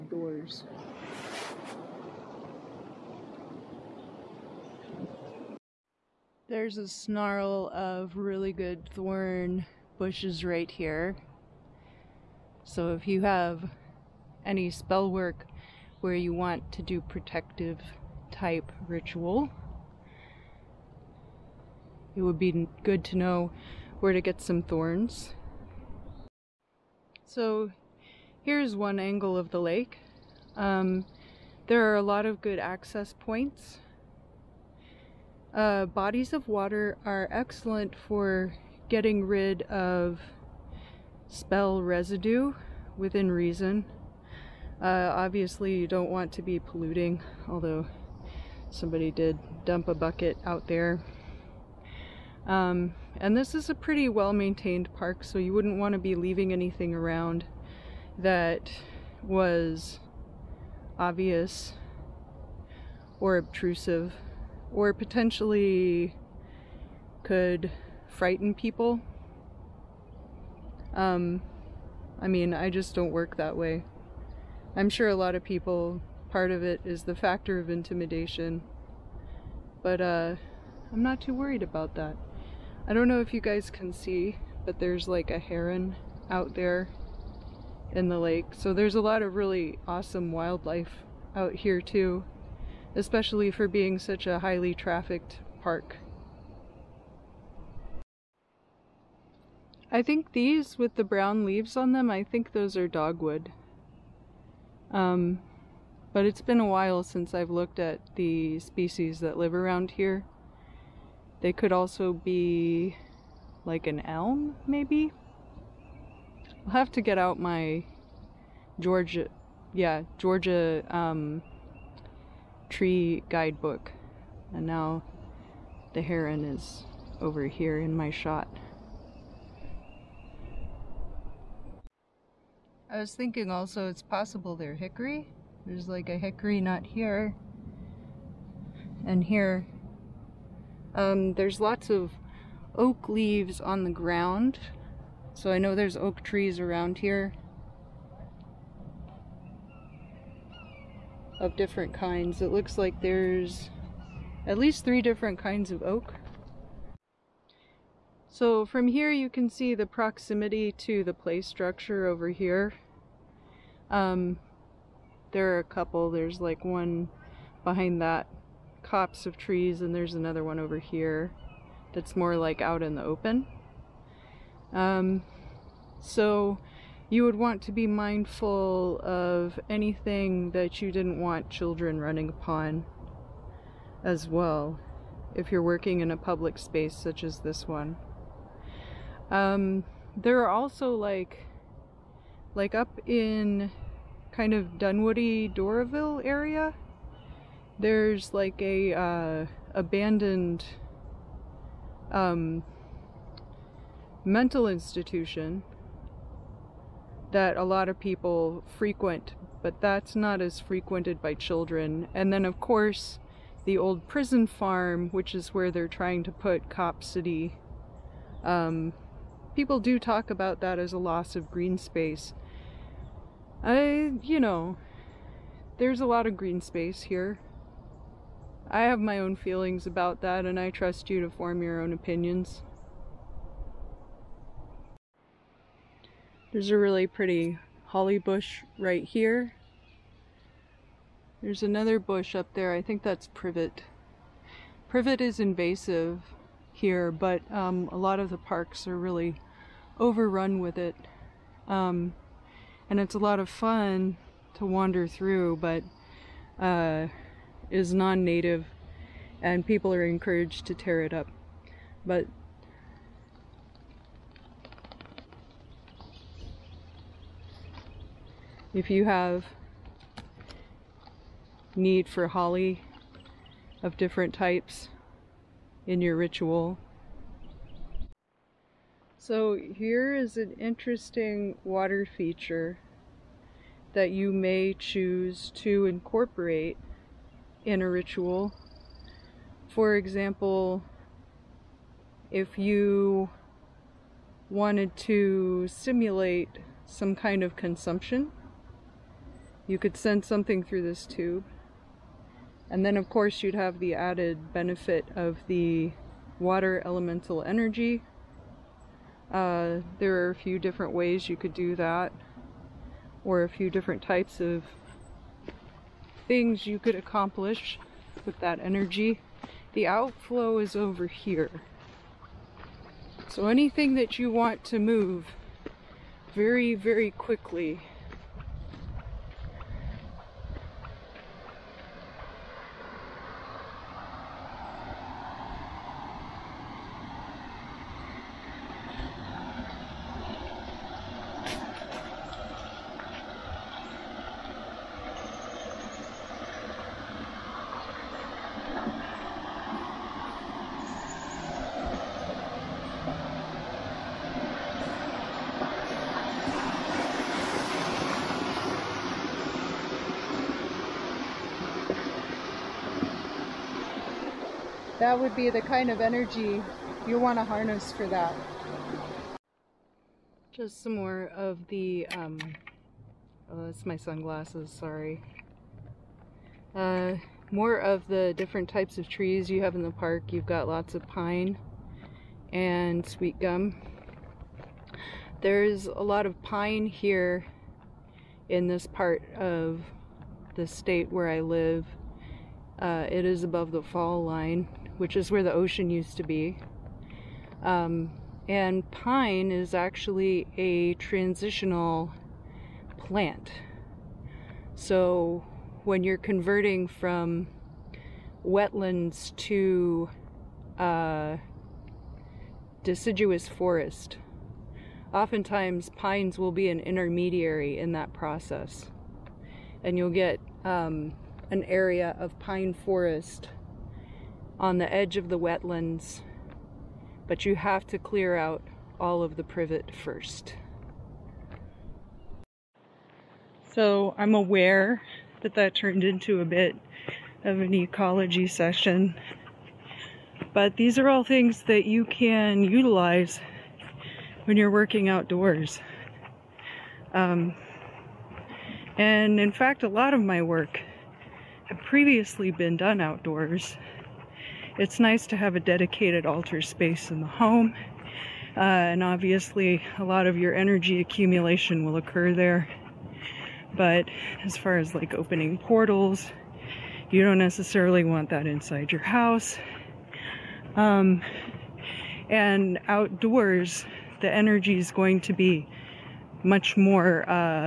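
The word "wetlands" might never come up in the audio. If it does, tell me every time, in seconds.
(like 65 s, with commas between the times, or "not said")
408 s, 425 s.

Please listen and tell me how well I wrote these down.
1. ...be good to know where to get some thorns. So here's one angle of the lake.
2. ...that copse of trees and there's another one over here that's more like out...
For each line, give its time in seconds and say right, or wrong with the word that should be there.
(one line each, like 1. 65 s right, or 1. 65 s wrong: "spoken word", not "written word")
1. 22 s right
2. 168 s right.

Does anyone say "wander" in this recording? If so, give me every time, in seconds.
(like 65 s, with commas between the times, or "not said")
254 s.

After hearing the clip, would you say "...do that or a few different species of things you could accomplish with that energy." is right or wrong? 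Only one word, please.
wrong.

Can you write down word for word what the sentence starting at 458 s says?
Uh, and obviously a lot of your energy accumulation will occur there.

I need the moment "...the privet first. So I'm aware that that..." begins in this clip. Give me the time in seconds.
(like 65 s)
429 s.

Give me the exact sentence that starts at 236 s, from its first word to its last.
There's a really pretty holly bush right here.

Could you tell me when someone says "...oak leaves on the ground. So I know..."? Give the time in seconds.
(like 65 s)
142 s.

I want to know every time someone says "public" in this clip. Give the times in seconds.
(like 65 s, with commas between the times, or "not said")
186 s.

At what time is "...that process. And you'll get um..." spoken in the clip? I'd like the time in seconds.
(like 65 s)
417 s.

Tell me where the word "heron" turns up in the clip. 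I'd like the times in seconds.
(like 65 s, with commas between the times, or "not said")
85 s, 126 s.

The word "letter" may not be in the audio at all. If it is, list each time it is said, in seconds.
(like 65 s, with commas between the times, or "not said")
not said.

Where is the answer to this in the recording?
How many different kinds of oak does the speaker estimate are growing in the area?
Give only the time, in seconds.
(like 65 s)
154 s.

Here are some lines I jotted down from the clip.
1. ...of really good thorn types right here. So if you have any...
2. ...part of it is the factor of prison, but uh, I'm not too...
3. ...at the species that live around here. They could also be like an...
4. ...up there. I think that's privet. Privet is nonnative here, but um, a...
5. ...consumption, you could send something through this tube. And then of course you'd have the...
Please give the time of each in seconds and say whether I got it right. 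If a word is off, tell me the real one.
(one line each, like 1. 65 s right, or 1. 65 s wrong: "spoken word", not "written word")
1. 7 s wrong: "bushes", not "types"
2. 76 s wrong: "intimidation", not "prison"
3. 107 s right
4. 242 s wrong: "invasive", not "nonnative"
5. 297 s right.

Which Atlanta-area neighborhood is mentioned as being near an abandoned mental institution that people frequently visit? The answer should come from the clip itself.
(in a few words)
Dunwoody Doraville.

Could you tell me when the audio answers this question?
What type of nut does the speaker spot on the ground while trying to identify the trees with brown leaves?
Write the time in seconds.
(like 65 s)
136 s.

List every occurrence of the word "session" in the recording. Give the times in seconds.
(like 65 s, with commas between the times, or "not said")
438 s.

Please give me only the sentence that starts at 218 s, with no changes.
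Um, people do talk about that as a loss of green space.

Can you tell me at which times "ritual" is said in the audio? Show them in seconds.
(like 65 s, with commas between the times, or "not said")
18 s, 276 s, 287 s.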